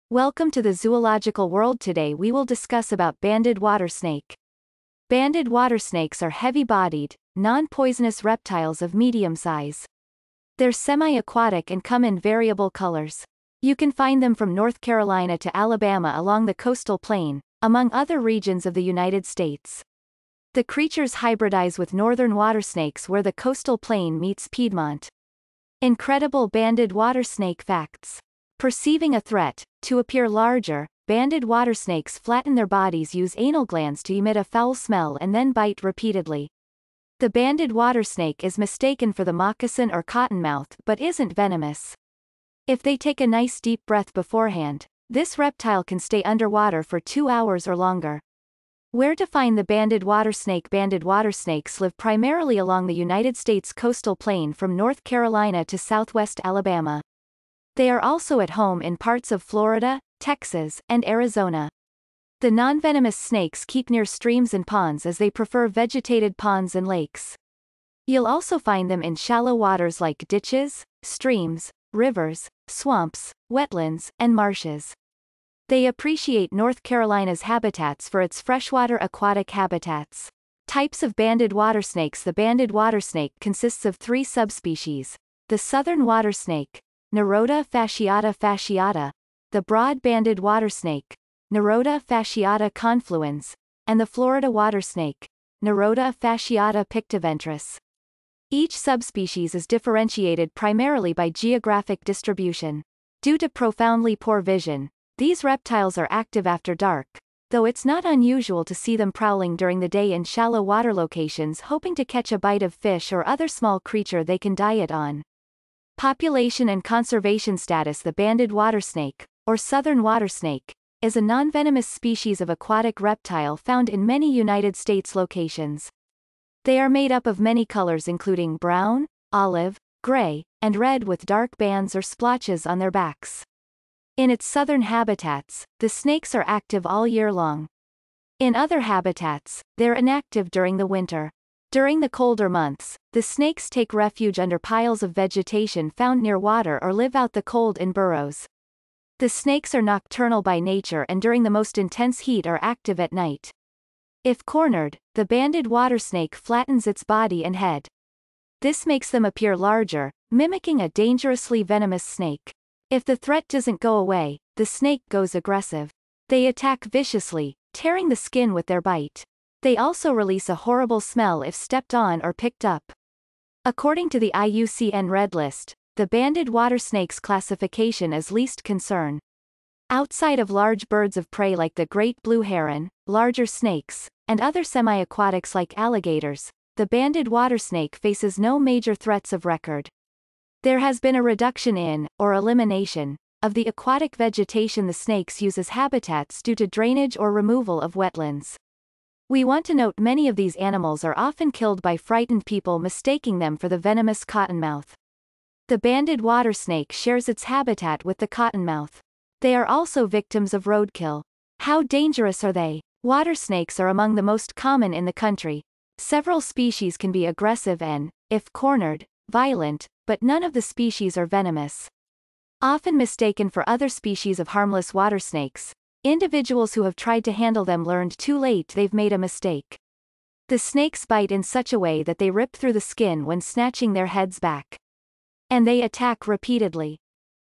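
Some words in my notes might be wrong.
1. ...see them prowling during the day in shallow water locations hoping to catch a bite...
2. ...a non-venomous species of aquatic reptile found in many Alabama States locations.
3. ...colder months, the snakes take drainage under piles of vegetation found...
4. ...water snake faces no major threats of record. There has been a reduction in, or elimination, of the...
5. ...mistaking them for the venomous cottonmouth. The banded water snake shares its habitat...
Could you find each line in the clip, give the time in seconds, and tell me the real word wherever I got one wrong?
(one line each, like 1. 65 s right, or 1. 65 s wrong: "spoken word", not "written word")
1. 108 s right
2. 121 s wrong: "United", not "Alabama"
3. 142 s wrong: "refuge", not "drainage"
4. 187 s right
5. 202 s right.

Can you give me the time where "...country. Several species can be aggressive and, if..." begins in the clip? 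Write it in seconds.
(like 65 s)
215 s.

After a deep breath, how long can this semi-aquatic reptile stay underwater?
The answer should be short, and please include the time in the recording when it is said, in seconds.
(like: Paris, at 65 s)
2 hours, at 46 s.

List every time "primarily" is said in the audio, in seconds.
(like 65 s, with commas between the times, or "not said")
51 s, 100 s.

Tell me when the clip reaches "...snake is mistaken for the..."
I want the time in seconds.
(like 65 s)
38 s.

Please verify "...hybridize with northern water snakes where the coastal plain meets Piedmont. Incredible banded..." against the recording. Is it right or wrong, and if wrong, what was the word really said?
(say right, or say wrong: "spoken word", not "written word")
right.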